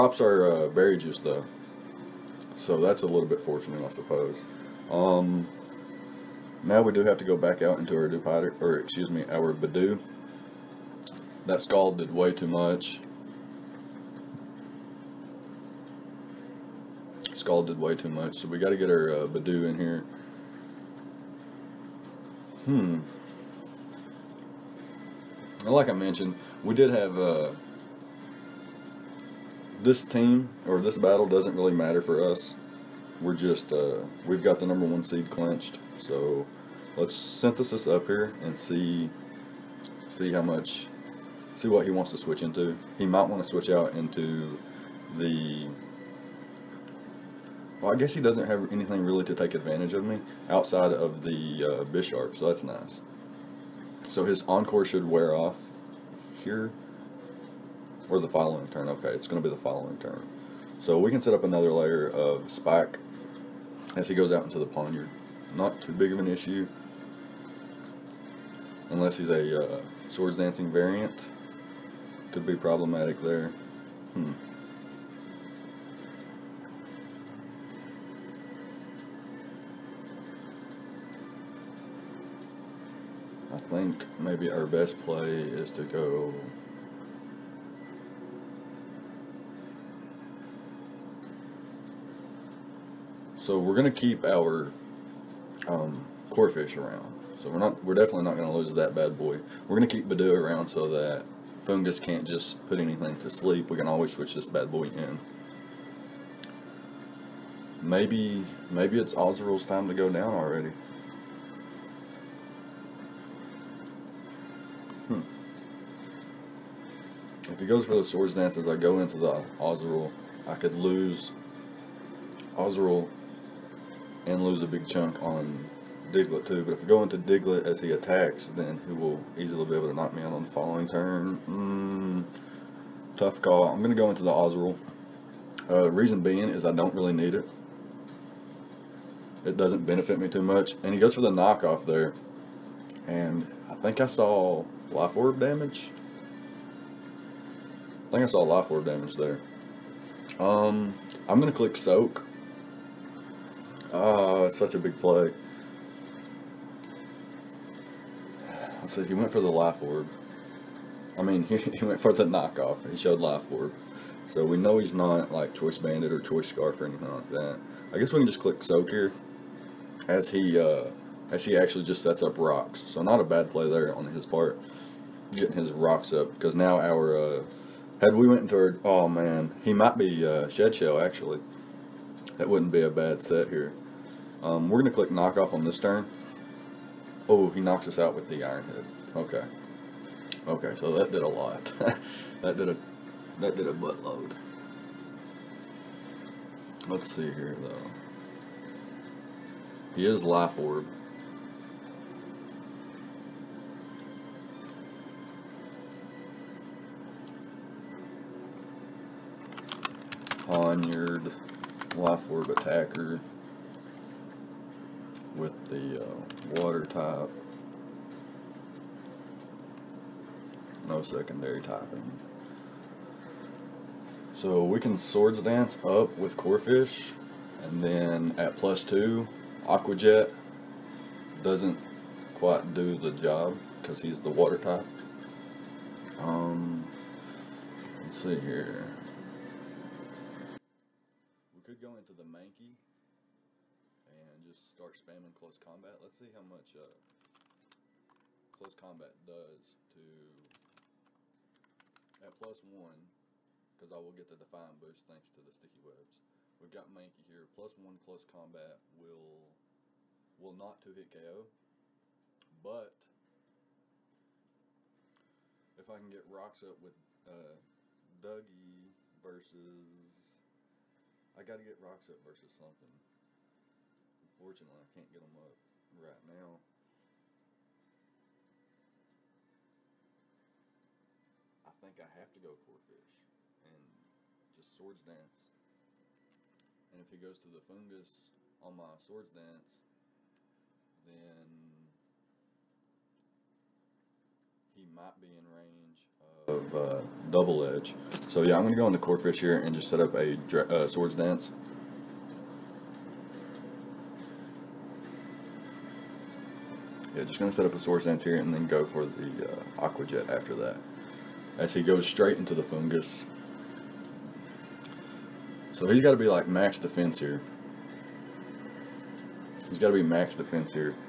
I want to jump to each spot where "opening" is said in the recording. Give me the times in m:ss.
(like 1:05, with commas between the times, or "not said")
not said.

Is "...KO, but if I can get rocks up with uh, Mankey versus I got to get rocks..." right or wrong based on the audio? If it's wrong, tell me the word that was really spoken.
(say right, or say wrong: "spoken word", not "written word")
wrong: "Dougie", not "Mankey".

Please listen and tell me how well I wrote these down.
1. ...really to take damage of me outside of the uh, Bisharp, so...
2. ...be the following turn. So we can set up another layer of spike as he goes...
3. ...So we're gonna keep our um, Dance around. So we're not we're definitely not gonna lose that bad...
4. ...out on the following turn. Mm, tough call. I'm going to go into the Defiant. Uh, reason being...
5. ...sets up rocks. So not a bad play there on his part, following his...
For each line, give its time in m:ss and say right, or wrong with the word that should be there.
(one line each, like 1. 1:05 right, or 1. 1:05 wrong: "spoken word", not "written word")
1. 0:49 wrong: "advantage", not "damage"
2. 0:59 right
3. 1:33 wrong: "Corphish", not "Dance"
4. 2:10 wrong: "Azurill", not "Defiant"
5. 2:52 wrong: "getting", not "following".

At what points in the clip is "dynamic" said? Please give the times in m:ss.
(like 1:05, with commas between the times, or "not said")
not said.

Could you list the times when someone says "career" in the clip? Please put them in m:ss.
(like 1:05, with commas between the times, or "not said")
not said.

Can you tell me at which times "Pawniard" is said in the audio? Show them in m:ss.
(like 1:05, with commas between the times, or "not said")
1:04, 3:30.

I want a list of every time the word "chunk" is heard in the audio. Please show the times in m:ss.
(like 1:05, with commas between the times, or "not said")
2:04.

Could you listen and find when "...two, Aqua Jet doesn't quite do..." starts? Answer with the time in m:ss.
3:48.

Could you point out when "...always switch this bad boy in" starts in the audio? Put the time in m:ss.
1:43.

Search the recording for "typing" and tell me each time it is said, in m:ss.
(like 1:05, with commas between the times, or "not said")
3:41.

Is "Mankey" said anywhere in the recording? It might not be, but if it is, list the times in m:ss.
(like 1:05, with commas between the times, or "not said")
4:02, 4:16.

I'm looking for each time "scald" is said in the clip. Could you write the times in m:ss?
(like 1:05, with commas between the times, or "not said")
0:11, 0:17.